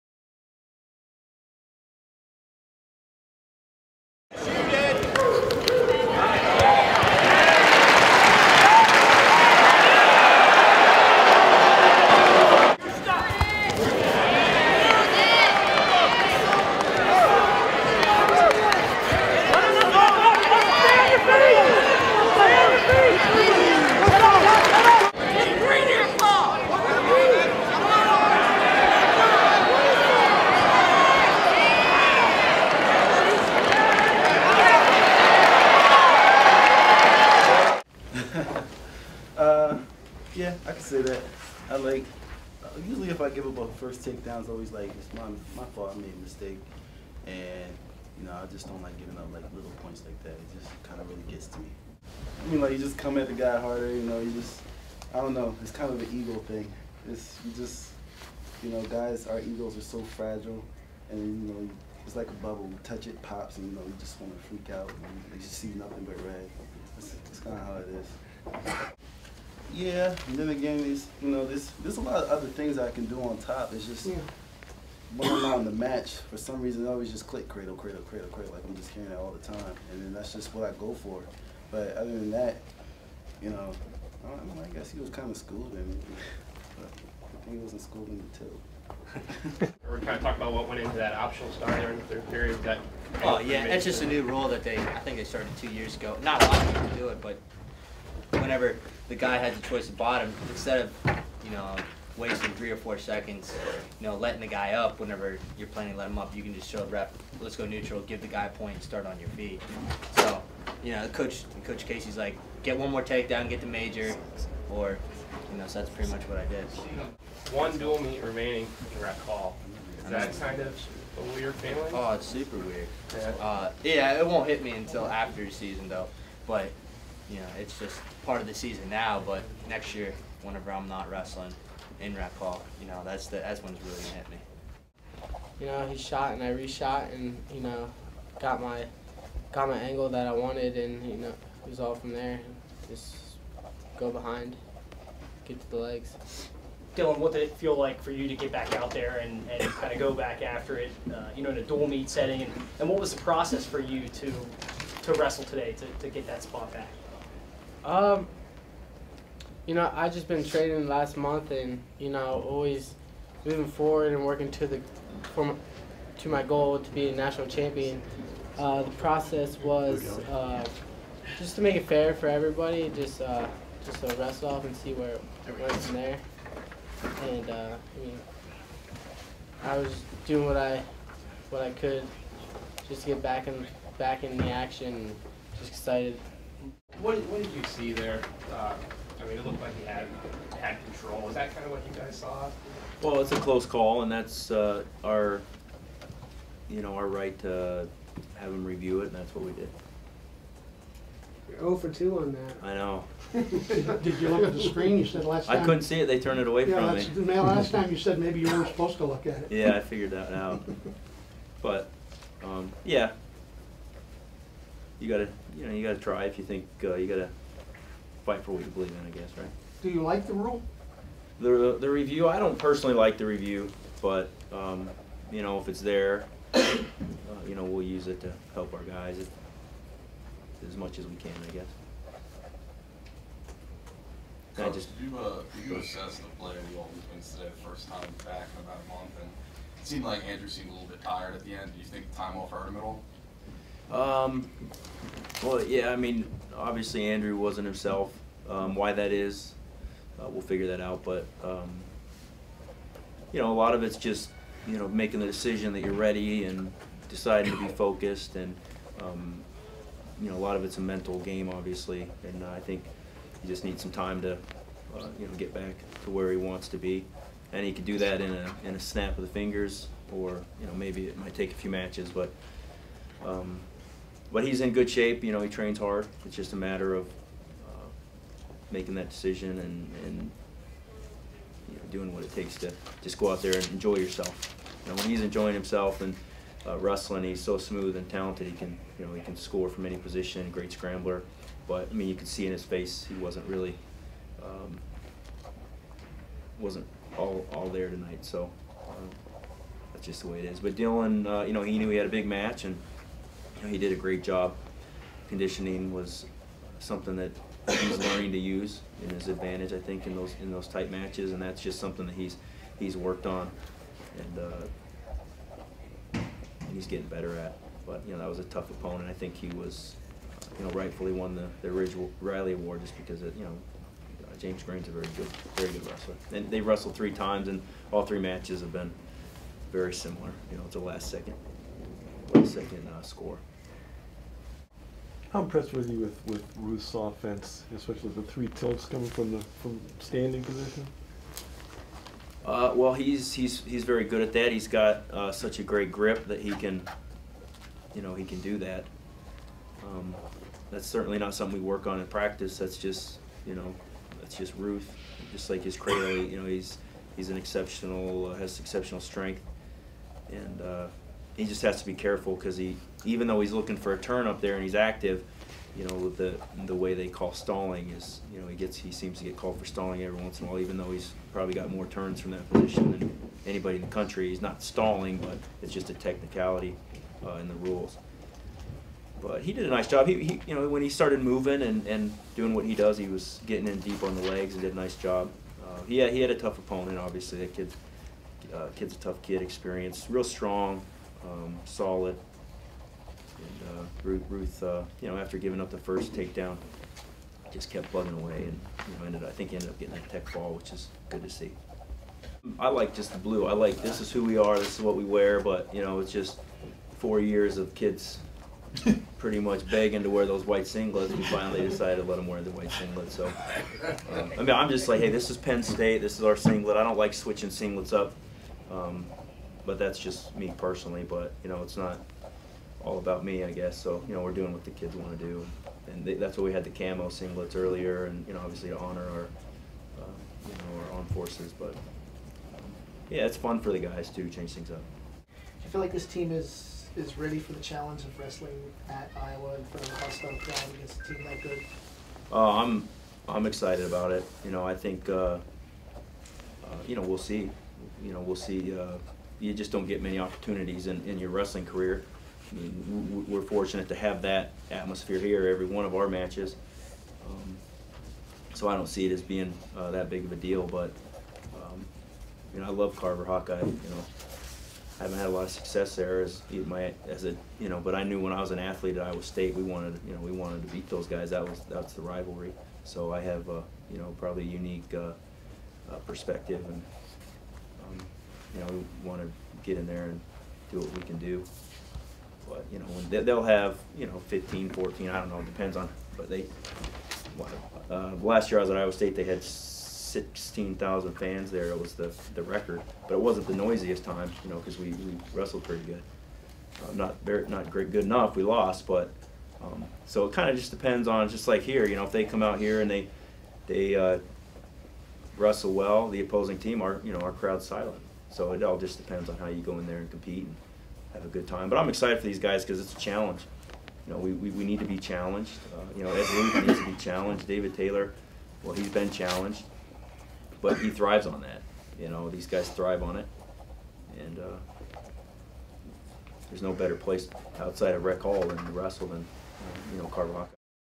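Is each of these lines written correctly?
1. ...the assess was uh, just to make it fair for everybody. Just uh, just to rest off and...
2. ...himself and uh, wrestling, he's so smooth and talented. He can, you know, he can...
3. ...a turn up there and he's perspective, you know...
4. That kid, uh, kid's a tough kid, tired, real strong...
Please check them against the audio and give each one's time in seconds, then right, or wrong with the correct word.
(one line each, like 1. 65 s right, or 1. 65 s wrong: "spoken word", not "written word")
1. 168 s wrong: "process", not "assess"
2. 285 s right
3. 363 s wrong: "active", not "perspective"
4. 387 s wrong: "experienced", not "tired".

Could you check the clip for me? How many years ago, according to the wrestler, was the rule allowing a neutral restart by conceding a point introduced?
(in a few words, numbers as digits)
2 years.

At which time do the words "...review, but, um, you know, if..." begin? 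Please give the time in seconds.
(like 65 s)
223 s.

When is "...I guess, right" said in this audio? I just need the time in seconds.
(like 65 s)
219 s.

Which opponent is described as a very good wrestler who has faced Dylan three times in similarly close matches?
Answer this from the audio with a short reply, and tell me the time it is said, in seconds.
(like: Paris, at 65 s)
James Green, at 324 s.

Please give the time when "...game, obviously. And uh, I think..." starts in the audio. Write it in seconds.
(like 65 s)
261 s.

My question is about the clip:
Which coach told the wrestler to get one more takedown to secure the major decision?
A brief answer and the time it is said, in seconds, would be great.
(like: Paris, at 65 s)
Coach Casey, at 111 s.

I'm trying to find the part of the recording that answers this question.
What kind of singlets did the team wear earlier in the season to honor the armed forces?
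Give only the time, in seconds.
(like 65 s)
426 s.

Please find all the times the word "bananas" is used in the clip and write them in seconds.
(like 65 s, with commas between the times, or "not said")
not said.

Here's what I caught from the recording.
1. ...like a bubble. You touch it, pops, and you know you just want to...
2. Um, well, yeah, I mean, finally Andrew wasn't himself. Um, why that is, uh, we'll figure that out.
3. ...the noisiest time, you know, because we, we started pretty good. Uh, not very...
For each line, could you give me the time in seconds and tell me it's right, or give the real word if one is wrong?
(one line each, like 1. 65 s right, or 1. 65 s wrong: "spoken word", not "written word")
1. 62 s right
2. 243 s wrong: "obviously", not "finally"
3. 493 s wrong: "wrestled", not "started".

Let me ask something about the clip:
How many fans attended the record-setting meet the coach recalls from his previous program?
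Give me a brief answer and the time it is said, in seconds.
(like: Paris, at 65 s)
16,000, at 489 s.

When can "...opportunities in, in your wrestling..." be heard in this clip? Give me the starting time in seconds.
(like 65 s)
450 s.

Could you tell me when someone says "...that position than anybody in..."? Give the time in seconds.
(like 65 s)
372 s.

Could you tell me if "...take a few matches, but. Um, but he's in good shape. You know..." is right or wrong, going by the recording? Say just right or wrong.
right.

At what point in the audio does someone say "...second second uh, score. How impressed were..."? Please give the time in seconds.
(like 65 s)
331 s.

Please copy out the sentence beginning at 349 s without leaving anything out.
Um, that's certainly not something we work on in practice.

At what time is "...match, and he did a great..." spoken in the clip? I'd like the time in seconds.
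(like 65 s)
302 s.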